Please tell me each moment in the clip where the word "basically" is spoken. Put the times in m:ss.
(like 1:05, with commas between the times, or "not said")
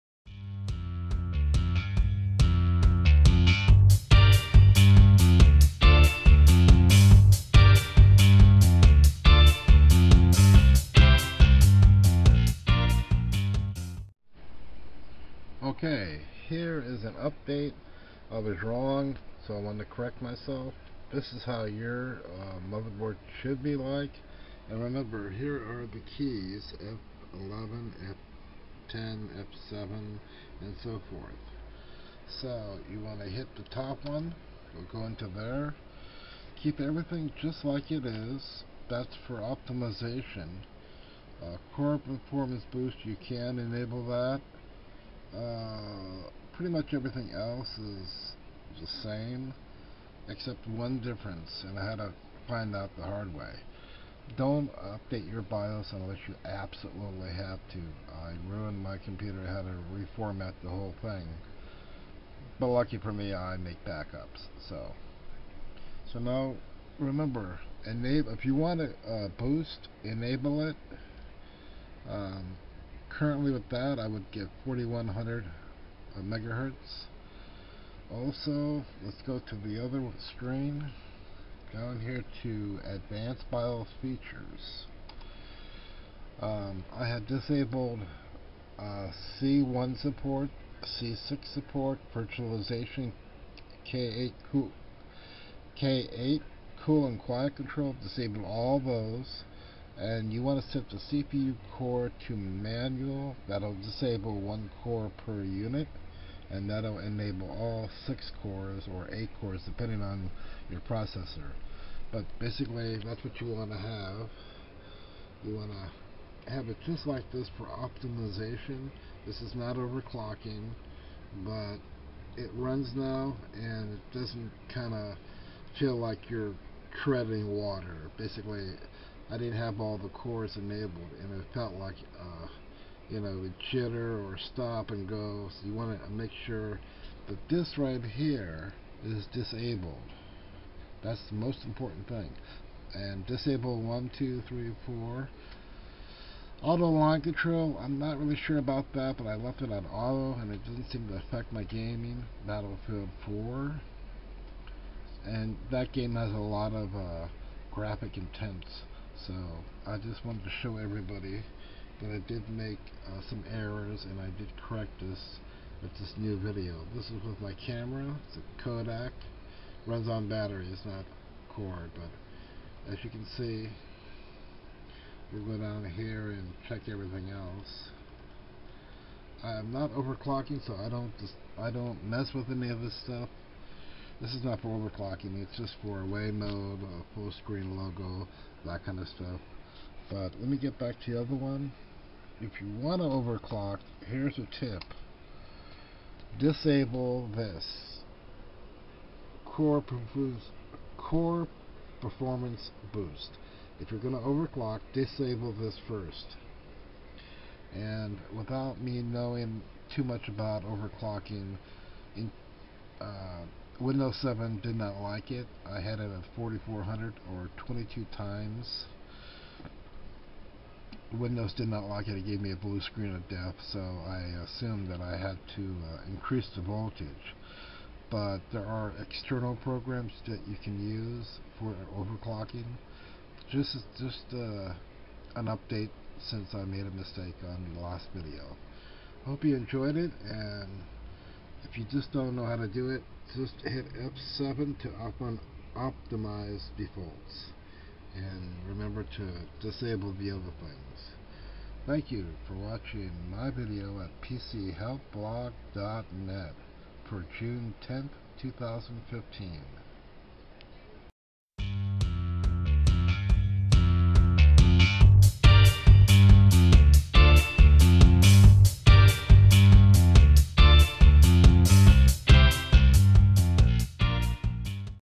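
1:52, 2:08.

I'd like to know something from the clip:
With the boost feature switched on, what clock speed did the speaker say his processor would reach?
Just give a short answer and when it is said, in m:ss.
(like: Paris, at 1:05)
4100 megahertz, at 1:14.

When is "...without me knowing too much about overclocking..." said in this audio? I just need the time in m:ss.
3:28.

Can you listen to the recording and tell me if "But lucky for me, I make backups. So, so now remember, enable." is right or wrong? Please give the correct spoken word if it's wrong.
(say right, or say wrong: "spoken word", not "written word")
right.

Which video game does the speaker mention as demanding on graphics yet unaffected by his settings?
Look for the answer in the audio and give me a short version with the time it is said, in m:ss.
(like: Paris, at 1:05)
Battlefield 4, at 2:32.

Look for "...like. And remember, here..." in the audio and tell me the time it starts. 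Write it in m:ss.
0:23.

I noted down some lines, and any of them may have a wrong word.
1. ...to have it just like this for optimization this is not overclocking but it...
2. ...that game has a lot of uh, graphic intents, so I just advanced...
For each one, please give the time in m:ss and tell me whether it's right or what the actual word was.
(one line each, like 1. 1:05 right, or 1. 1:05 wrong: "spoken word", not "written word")
1. 1:55 right
2. 2:35 wrong: "wanted", not "advanced".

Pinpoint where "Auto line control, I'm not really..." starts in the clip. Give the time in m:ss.
2:26.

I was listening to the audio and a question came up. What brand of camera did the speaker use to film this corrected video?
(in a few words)
Kodak.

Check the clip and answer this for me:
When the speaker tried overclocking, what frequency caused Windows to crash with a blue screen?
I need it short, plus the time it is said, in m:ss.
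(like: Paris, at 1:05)
4400, at 3:36.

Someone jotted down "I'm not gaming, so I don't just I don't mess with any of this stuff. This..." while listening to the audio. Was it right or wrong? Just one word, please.
wrong.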